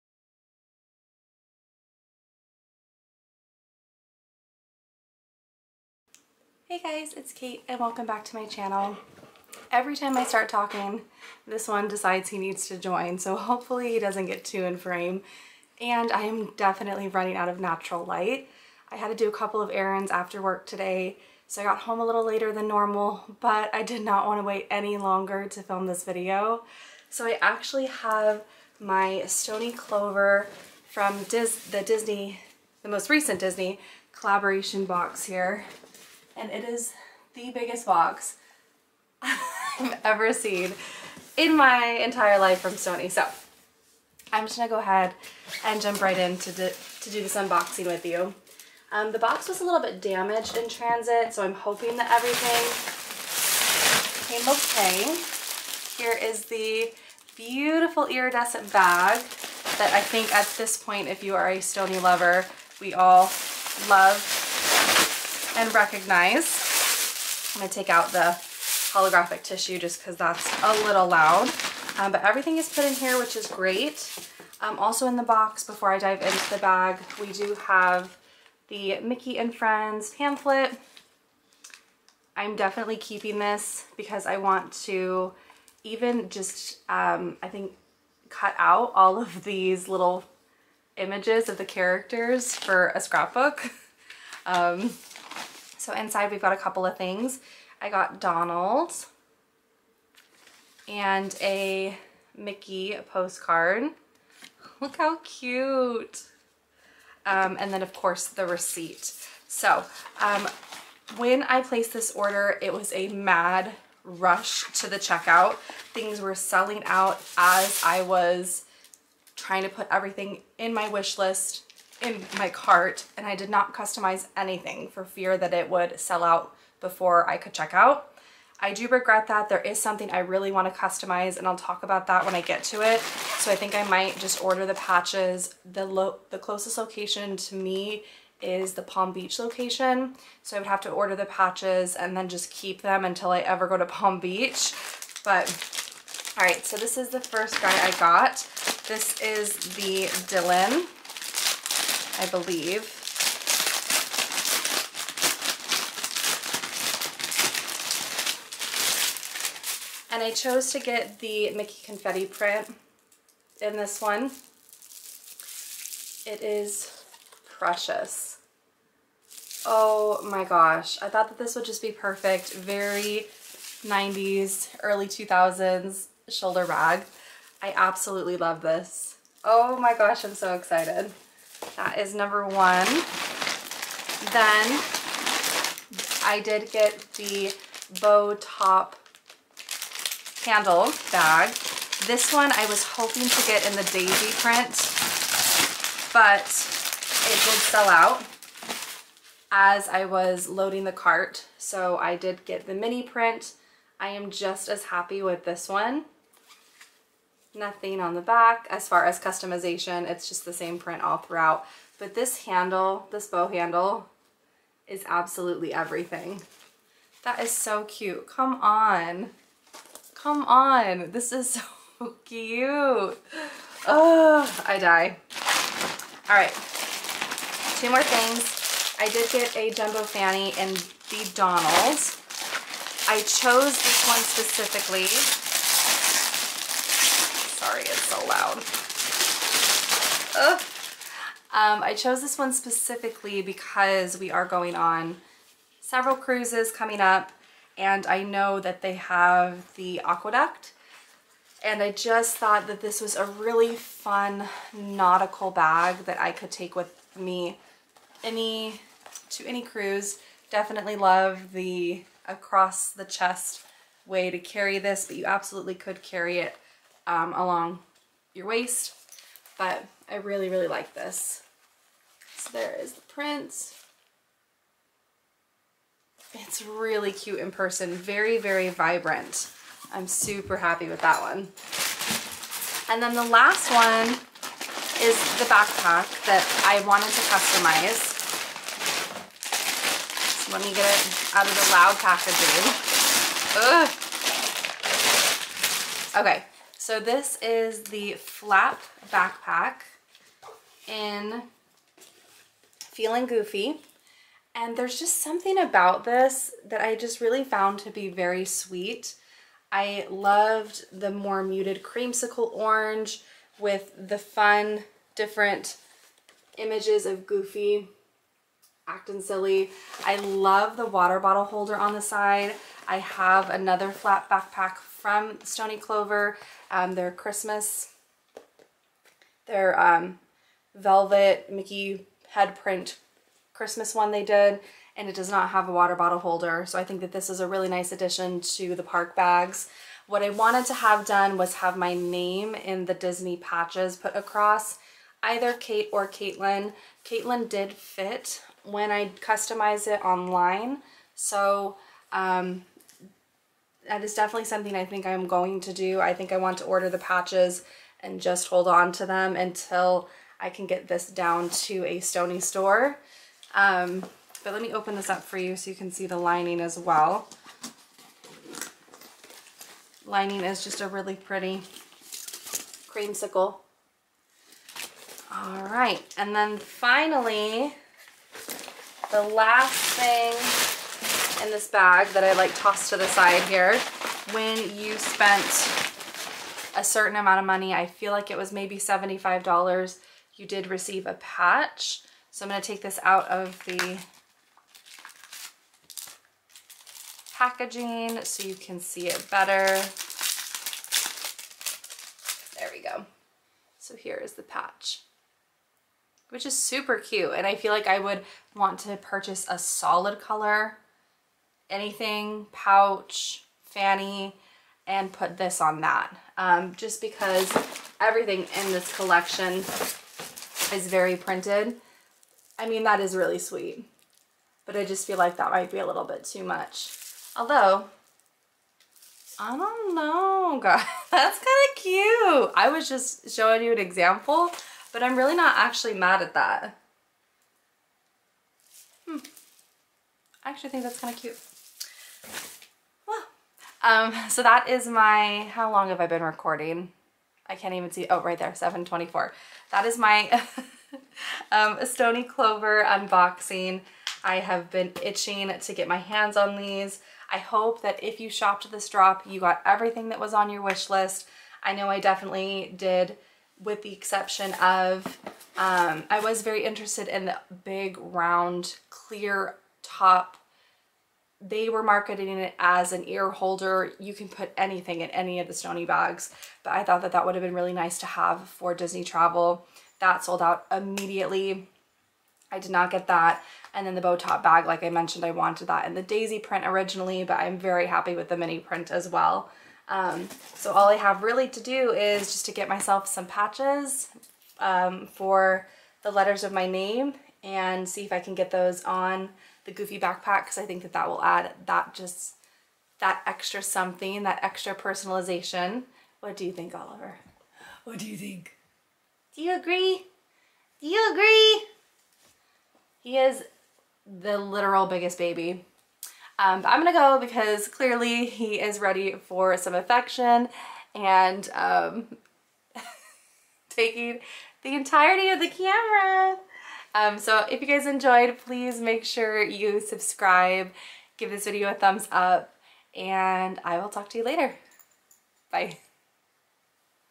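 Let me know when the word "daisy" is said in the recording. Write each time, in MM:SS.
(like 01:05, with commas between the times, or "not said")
03:13, 08:06.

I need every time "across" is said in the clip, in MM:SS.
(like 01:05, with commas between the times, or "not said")
04:22, 05:44.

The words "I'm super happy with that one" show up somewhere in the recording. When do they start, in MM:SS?
04:39.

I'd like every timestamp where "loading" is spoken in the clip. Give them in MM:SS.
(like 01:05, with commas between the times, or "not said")
03:20.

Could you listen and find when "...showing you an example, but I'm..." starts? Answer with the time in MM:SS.
07:13.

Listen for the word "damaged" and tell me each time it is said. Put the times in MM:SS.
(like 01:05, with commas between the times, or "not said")
00:50.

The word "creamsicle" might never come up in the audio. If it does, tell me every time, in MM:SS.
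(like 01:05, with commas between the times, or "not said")
05:11, 06:12.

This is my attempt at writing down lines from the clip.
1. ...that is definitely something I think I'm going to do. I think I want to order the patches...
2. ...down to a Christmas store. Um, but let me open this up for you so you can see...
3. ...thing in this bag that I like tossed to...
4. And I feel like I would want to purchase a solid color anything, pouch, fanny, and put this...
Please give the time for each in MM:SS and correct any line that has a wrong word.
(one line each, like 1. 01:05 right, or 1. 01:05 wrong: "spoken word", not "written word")
1. 05:53 right
2. 06:01 wrong: "Stoney", not "Christmas"
3. 06:19 right
4. 06:47 right.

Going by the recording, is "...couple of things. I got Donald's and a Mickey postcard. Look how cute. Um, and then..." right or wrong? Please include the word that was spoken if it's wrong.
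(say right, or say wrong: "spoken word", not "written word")
right.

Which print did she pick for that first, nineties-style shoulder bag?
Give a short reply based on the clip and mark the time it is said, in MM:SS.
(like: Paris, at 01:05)
Mickey Confetti, at 02:41.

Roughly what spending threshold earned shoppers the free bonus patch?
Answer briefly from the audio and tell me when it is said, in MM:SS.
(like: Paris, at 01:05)
$75, at 06:28.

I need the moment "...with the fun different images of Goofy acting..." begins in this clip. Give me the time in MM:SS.
05:13.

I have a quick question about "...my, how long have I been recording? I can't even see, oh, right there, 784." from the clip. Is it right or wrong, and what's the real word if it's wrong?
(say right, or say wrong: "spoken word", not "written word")
wrong: "724", not "784".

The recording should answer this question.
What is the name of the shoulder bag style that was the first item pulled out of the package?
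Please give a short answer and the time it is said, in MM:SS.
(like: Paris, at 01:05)
Dylan, at 02:30.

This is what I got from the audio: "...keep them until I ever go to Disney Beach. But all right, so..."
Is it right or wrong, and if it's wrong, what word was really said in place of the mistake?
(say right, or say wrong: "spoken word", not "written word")
wrong: "Palm", not "Disney".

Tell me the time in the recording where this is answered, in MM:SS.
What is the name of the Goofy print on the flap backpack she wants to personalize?
05:02.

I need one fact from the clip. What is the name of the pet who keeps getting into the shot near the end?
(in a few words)
Oliver.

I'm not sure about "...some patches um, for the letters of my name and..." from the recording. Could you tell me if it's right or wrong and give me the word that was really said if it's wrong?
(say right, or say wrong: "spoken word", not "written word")
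right.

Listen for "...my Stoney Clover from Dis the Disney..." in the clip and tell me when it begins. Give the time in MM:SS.
00:28.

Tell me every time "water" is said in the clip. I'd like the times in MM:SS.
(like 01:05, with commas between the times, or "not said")
05:20, 05:35.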